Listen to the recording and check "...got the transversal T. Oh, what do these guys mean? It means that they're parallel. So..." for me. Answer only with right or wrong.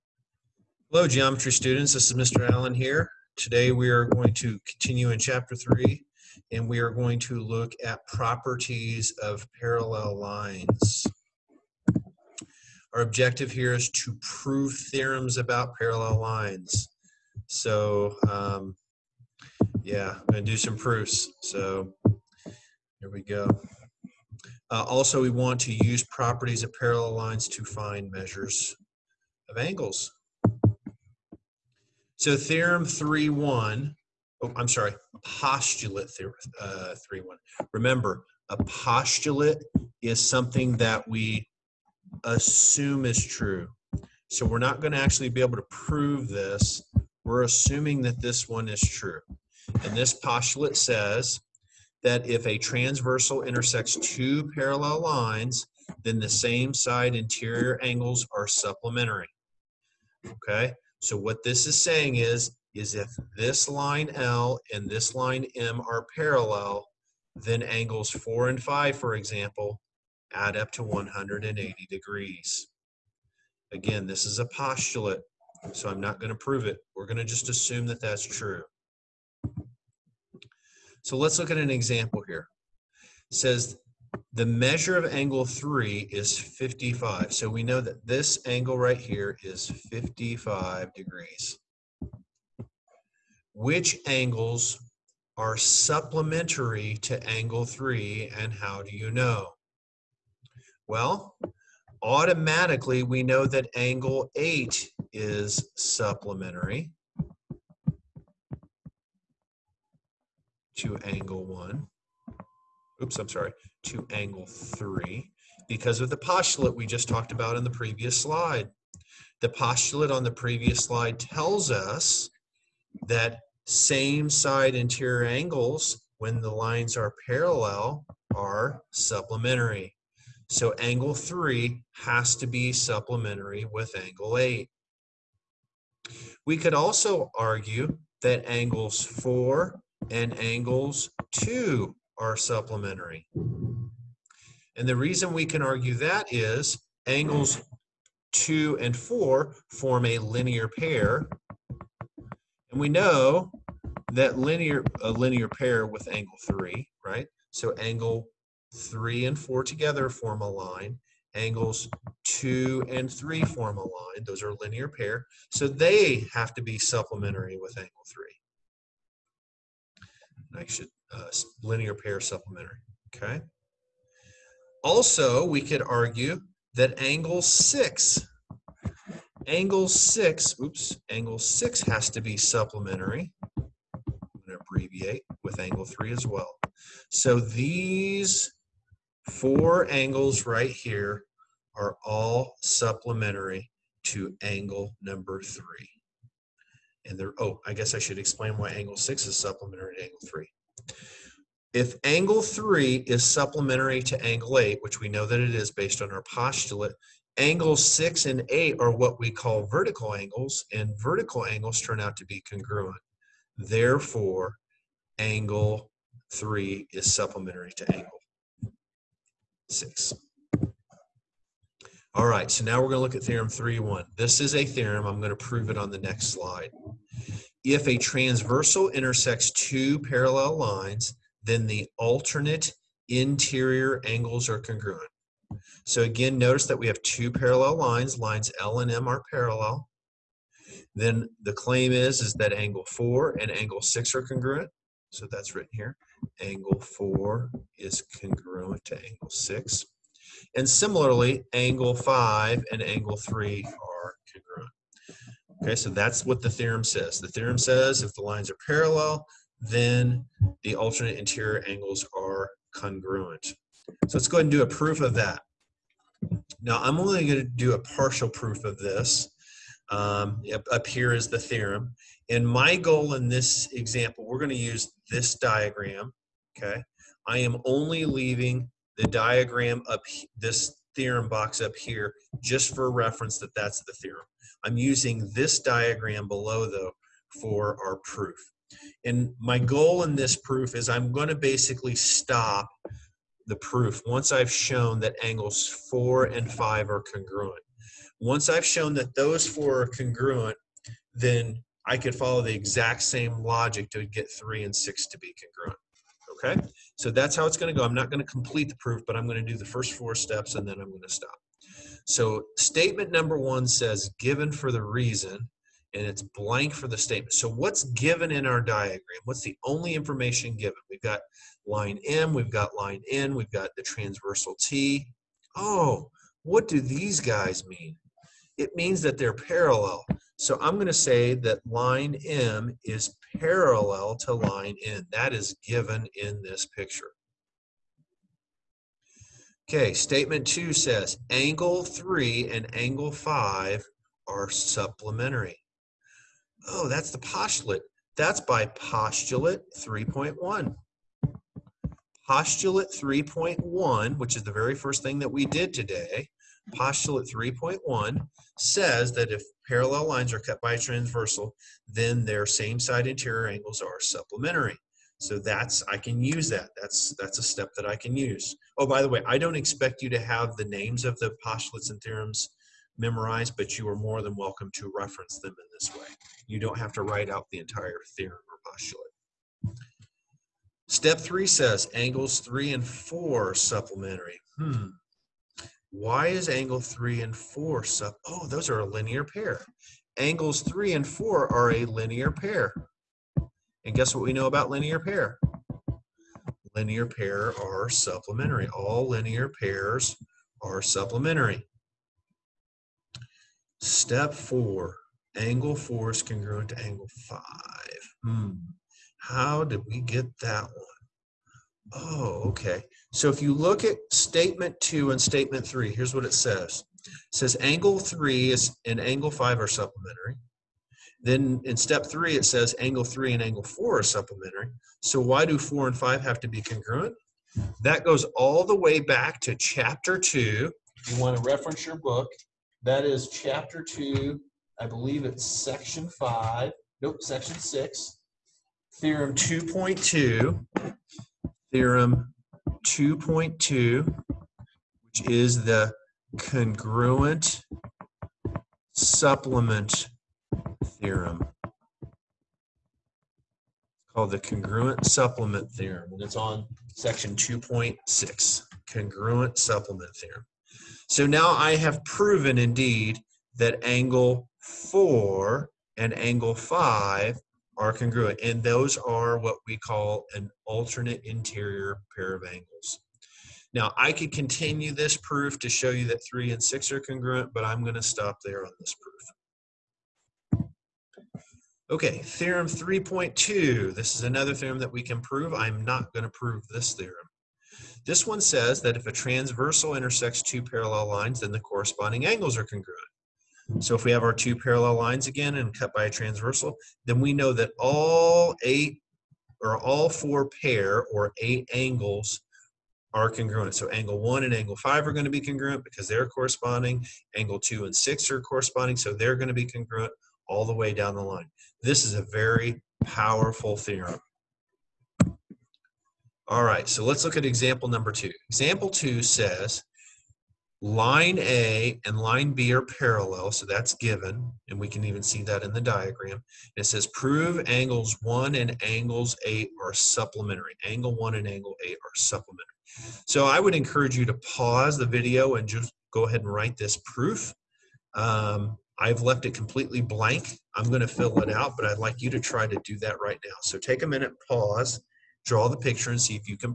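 right.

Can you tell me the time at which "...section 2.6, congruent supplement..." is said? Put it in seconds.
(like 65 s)
456 s.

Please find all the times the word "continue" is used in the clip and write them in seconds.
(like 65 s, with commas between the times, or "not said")
4 s, 474 s.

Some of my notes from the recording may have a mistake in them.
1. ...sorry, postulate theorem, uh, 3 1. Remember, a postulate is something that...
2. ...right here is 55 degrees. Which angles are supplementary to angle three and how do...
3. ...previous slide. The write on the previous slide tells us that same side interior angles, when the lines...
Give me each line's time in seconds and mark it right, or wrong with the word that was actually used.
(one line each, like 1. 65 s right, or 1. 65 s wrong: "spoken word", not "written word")
1. 34 s right
2. 88 s right
3. 117 s wrong: "postulate", not "write".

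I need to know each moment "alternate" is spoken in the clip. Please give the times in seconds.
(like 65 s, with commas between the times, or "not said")
231 s, 260 s, 470 s.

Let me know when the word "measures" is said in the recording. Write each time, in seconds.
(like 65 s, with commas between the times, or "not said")
28 s, 84 s.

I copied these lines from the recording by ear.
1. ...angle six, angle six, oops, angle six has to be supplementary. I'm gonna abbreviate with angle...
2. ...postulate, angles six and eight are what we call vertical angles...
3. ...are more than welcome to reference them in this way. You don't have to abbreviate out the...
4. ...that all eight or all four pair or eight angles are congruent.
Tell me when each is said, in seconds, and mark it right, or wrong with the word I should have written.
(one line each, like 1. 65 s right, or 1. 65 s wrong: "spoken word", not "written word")
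1. 177 s right
2. 206 s right
3. 373 s wrong: "write", not "abbreviate"
4. 497 s right.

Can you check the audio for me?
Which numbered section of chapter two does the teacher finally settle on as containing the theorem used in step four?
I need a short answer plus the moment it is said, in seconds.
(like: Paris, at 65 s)
6, at 437 s.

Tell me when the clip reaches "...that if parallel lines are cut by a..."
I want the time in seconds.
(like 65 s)
359 s.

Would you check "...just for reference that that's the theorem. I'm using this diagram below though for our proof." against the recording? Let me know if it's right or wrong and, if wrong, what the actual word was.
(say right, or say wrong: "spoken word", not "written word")
right.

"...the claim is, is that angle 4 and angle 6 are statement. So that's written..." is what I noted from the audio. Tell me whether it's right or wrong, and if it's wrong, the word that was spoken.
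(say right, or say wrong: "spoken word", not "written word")
wrong: "congruent", not "statement".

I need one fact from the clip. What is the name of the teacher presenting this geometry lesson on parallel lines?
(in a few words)
Mr. Allen.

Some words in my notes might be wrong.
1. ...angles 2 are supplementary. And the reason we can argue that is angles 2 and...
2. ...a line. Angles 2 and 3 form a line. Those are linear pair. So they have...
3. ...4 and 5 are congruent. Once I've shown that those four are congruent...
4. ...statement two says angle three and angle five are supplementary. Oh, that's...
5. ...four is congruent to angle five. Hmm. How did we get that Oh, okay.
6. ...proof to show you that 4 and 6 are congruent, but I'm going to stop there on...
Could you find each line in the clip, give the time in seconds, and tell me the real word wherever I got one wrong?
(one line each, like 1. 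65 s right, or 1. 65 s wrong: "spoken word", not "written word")
1. 140 s right
2. 160 s right
3. 295 s right
4. 339 s right
5. 405 s right
6. 475 s wrong: "3", not "4".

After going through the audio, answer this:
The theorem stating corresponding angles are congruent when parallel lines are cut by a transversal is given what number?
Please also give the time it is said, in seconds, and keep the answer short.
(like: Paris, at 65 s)
3.2, at 482 s.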